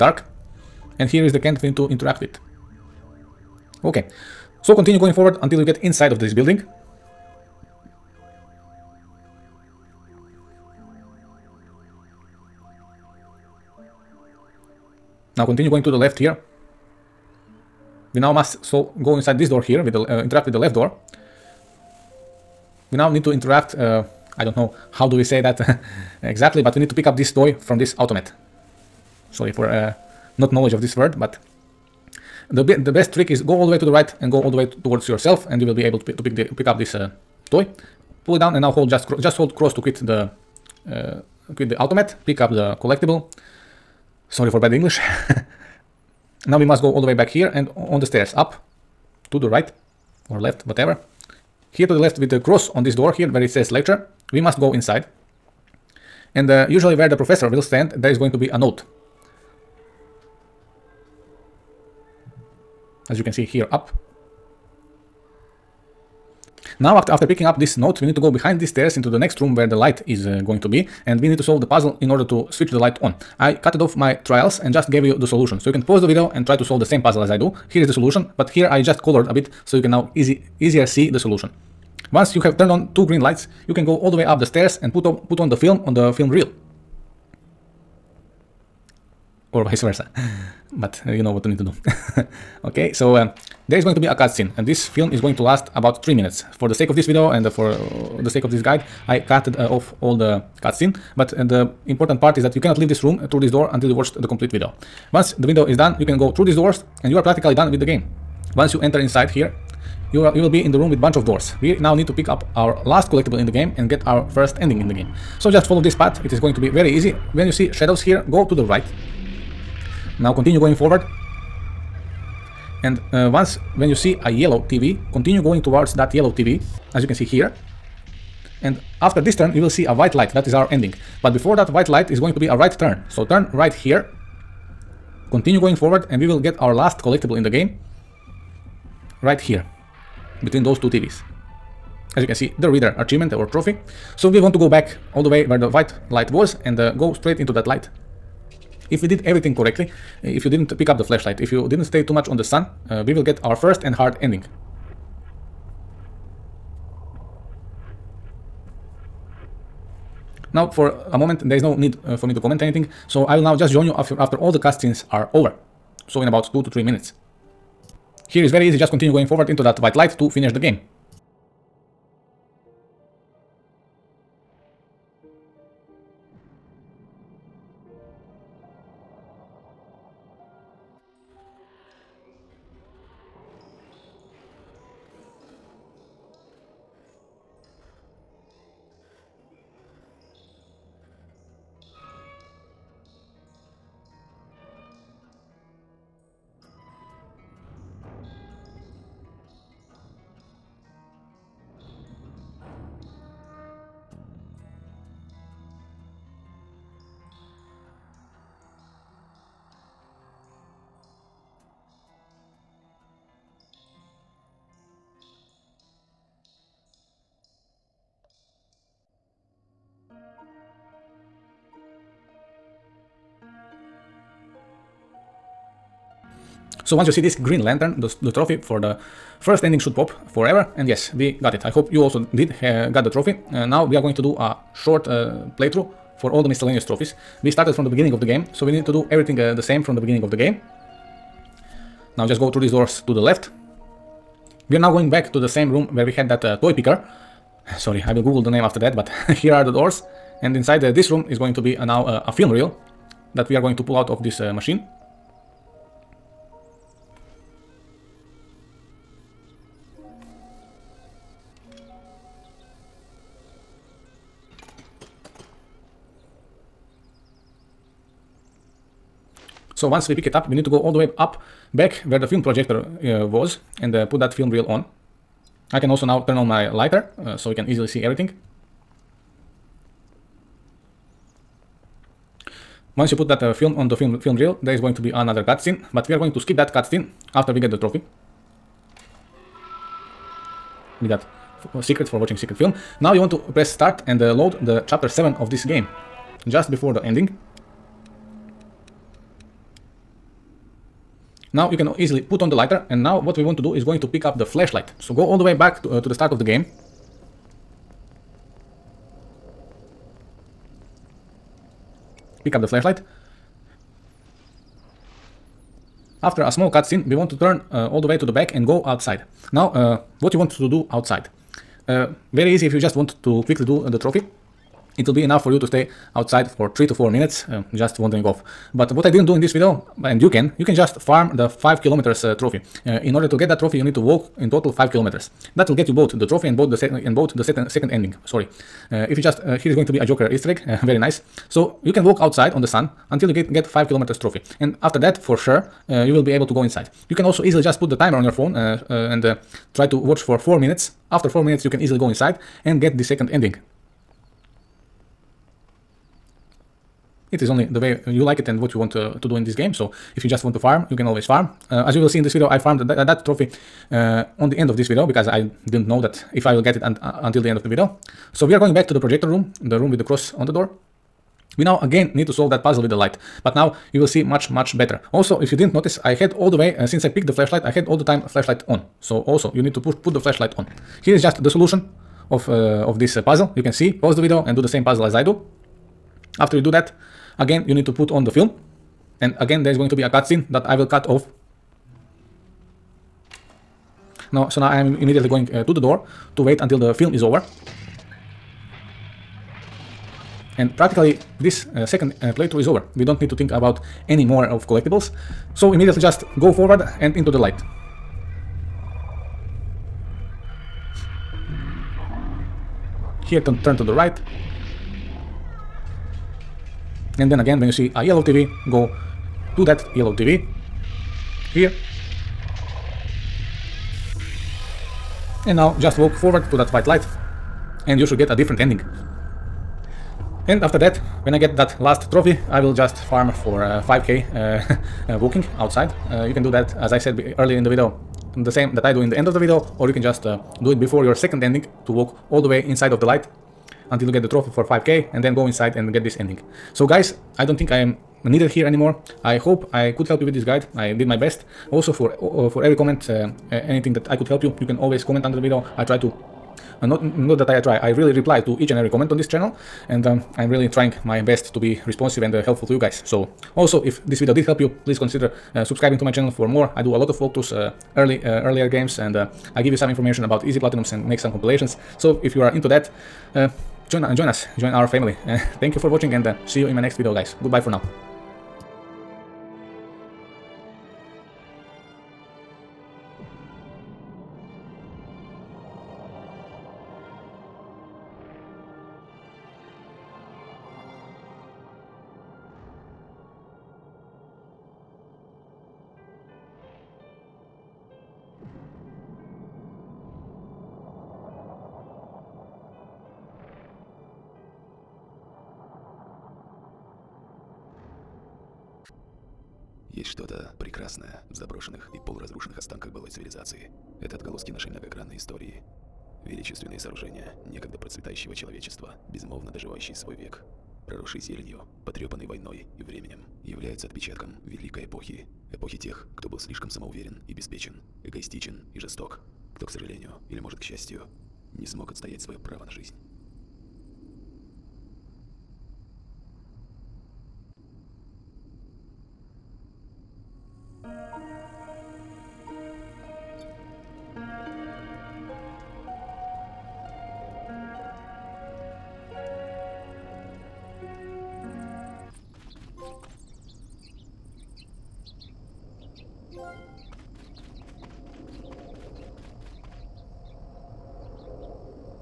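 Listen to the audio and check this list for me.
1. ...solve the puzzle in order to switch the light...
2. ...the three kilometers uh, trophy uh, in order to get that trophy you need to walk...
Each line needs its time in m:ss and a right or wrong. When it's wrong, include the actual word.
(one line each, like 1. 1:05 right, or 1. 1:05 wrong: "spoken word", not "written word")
1. 1:11 right
2. 5:31 wrong: "five", not "three".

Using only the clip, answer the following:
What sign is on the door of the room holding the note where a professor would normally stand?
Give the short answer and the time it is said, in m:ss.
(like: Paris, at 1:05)
Lecture, at 0:53.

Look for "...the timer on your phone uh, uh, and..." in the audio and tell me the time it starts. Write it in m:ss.
5:47.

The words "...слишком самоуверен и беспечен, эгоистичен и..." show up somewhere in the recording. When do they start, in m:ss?
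8:46.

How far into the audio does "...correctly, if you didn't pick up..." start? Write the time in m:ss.
2:29.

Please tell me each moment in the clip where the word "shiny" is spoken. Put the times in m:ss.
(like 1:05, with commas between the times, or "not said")
not said.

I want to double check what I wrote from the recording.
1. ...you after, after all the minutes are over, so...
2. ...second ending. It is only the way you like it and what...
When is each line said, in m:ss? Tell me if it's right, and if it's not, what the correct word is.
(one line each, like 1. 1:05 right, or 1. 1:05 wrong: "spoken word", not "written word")
1. 2:43 wrong: "cutscenes", not "minutes"
2. 5:53 right.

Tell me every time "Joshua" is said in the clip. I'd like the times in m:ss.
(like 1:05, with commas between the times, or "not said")
not said.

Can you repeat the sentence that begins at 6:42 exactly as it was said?
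We don't need to think about any more of collectibles.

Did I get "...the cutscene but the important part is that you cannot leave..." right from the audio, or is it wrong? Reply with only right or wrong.
right.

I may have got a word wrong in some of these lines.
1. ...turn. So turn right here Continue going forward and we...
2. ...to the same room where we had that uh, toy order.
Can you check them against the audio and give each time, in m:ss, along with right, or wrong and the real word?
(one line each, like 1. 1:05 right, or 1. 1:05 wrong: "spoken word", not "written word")
1. 2:12 right
2. 4:05 wrong: "picker", not "order".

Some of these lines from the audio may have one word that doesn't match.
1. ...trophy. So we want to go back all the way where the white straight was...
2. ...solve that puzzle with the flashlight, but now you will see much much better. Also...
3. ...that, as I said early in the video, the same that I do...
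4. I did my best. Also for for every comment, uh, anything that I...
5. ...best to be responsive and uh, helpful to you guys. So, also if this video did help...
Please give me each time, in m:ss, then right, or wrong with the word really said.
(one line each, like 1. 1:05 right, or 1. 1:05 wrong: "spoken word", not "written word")
1. 2:23 wrong: "light", not "straight"
2. 6:12 wrong: "light", not "flashlight"
3. 7:16 right
4. 7:30 right
5. 7:41 right.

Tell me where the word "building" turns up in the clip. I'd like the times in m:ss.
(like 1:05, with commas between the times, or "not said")
0:06.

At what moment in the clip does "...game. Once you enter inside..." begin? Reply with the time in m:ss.
1:47.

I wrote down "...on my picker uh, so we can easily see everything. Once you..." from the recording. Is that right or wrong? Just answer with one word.
wrong.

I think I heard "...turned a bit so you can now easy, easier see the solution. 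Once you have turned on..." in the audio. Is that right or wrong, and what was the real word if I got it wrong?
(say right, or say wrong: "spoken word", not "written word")
wrong: "colored", not "turned".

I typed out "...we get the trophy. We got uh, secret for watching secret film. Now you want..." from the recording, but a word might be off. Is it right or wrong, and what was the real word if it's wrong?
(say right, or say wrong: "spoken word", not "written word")
right.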